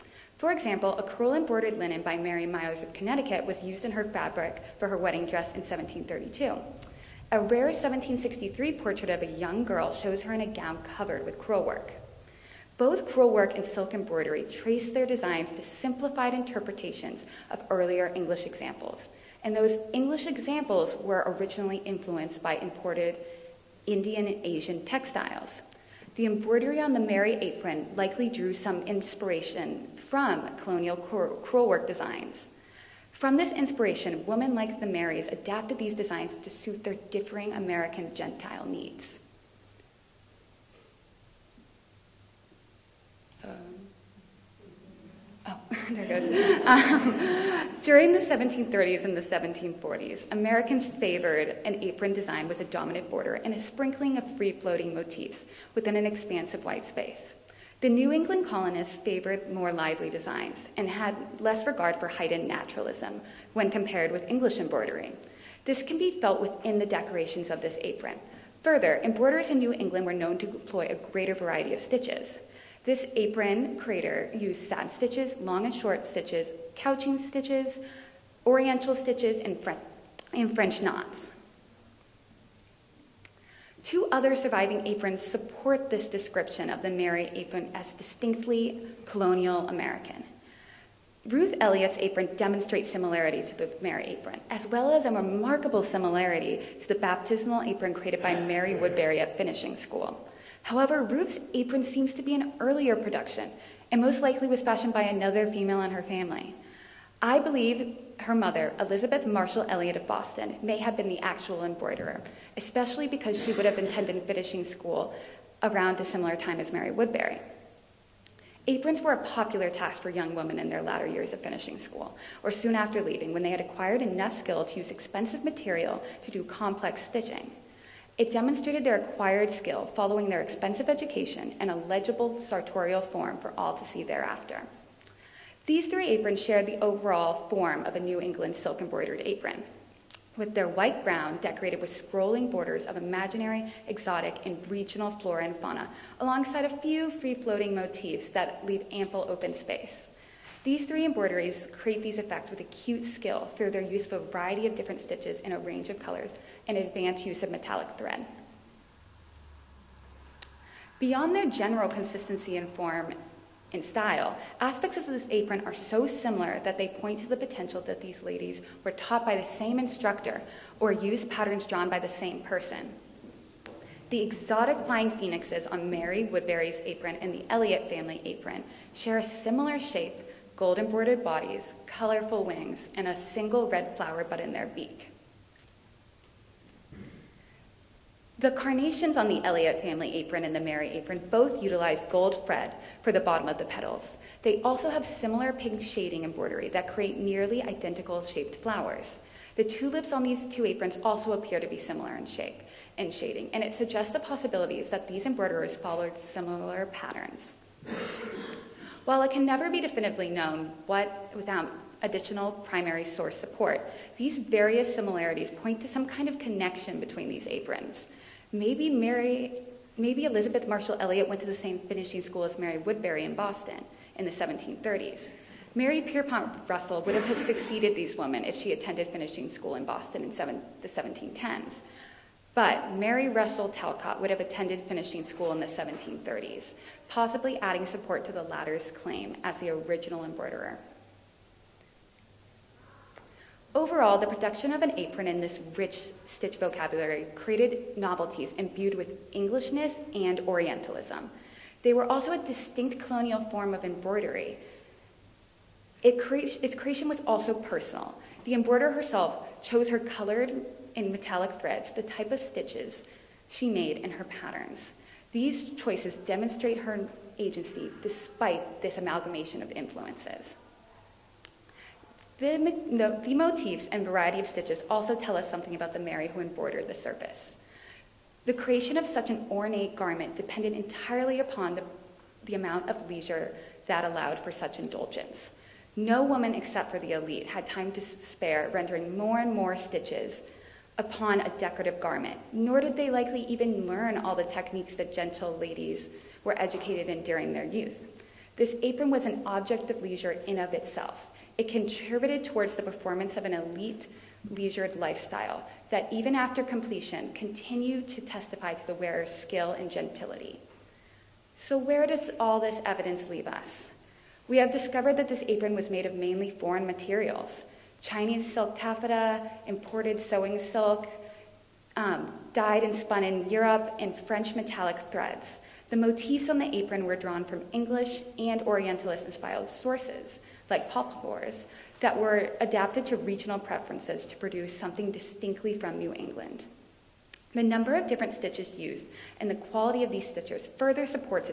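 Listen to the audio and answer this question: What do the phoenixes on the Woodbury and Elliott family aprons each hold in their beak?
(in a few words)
a single red flower bud.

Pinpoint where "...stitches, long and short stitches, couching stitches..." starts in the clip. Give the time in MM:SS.
01:14.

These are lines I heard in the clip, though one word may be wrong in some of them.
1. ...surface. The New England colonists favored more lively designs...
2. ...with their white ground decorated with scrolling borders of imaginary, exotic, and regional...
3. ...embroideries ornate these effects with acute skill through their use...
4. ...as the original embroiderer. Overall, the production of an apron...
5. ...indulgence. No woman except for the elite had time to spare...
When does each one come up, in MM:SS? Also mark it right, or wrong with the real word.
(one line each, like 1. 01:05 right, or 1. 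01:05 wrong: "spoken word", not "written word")
1. 00:56 wrong: "space", not "surface"
2. 02:20 right
3. 02:31 wrong: "create", not "ornate"
4. 03:59 right
5. 04:44 right.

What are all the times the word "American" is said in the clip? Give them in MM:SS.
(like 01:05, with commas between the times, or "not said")
00:37, 00:50, 01:29.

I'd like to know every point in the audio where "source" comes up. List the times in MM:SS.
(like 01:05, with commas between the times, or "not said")
03:33, 05:29.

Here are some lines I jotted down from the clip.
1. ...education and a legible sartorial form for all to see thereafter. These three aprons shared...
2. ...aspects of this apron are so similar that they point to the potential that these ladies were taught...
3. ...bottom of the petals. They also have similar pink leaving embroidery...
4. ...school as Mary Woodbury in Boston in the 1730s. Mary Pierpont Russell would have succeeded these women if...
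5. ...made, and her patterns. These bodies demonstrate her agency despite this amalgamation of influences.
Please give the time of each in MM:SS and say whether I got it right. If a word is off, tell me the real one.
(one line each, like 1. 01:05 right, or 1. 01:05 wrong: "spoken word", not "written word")
1. 02:10 right
2. 02:44 right
3. 03:13 wrong: "shading", not "leaving"
4. 03:42 right
5. 04:23 wrong: "choices", not "bodies".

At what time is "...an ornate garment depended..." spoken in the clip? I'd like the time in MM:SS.
04:39.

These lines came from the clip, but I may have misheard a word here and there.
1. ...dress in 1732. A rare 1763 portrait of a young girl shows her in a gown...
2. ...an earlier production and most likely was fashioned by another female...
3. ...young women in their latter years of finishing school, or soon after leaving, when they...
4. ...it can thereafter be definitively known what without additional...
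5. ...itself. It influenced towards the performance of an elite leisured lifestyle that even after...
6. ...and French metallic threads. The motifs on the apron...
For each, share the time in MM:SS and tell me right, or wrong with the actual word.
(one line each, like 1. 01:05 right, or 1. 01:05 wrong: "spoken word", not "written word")
1. 00:05 right
2. 01:42 right
3. 02:00 right
4. 03:29 wrong: "never", not "thereafter"
5. 05:00 wrong: "contributed", not "influenced"
6. 05:23 right.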